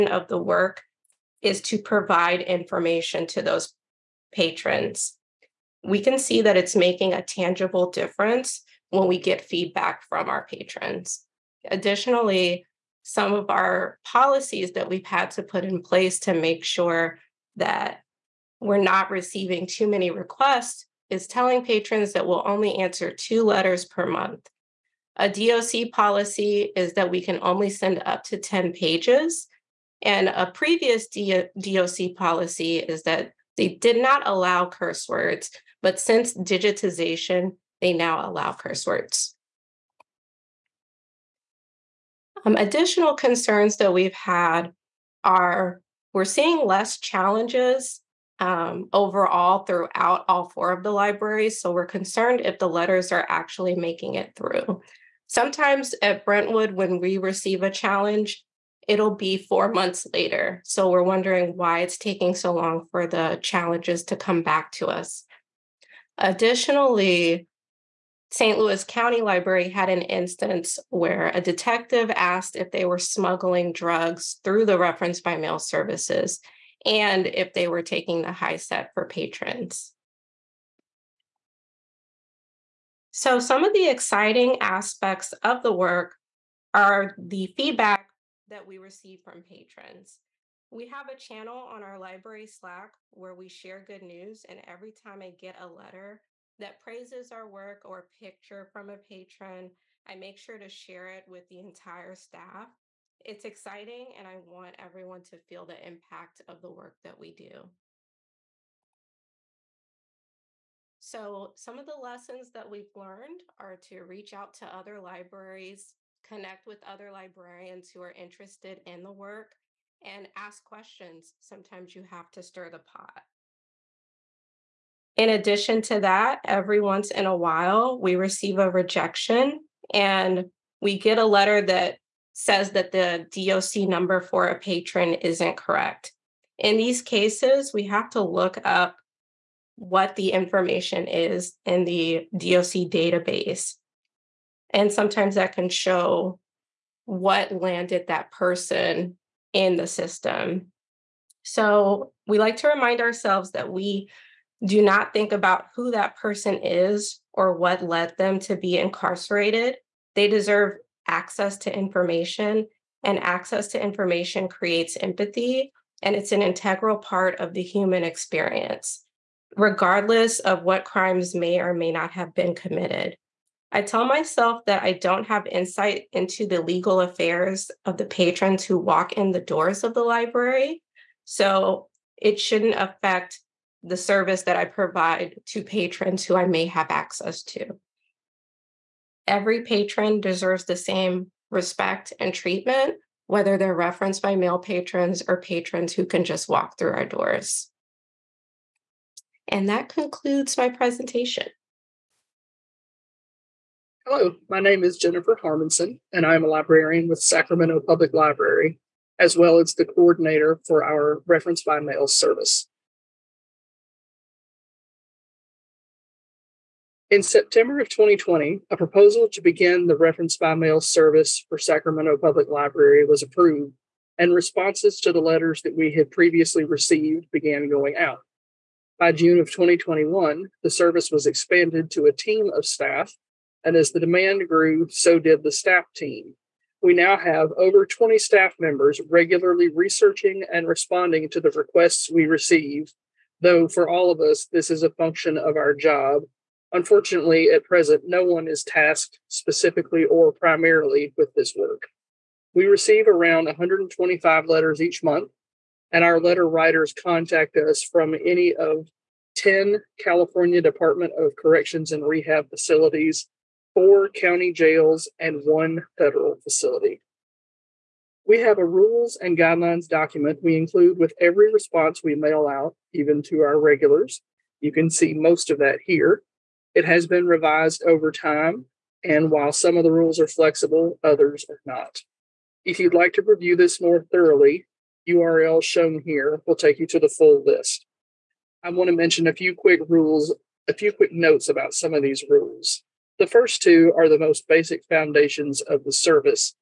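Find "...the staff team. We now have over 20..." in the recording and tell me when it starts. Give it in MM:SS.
03:55.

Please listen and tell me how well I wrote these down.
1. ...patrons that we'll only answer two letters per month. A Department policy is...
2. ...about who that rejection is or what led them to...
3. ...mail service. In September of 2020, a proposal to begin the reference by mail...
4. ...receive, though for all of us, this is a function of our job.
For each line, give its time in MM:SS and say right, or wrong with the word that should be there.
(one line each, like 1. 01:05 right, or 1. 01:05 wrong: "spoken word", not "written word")
1. 00:21 wrong: "DOC", not "Department"
2. 02:35 wrong: "person", not "rejection"
3. 03:31 right
4. 04:02 right.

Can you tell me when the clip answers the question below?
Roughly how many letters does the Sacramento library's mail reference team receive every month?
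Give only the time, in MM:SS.
04:13.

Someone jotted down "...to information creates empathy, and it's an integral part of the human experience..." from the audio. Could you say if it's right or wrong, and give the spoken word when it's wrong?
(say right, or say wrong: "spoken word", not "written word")
right.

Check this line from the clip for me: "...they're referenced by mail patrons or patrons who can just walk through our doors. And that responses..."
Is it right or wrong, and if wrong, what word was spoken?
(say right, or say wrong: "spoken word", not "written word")
wrong: "concludes", not "responses".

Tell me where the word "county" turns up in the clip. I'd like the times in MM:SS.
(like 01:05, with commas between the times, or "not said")
01:08, 04:24.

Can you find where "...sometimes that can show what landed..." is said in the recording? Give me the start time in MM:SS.
02:24.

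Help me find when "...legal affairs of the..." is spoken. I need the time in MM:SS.
02:56.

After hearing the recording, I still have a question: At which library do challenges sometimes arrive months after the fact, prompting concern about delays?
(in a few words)
Brentwood.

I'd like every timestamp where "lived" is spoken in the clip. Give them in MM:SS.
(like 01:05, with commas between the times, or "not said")
not said.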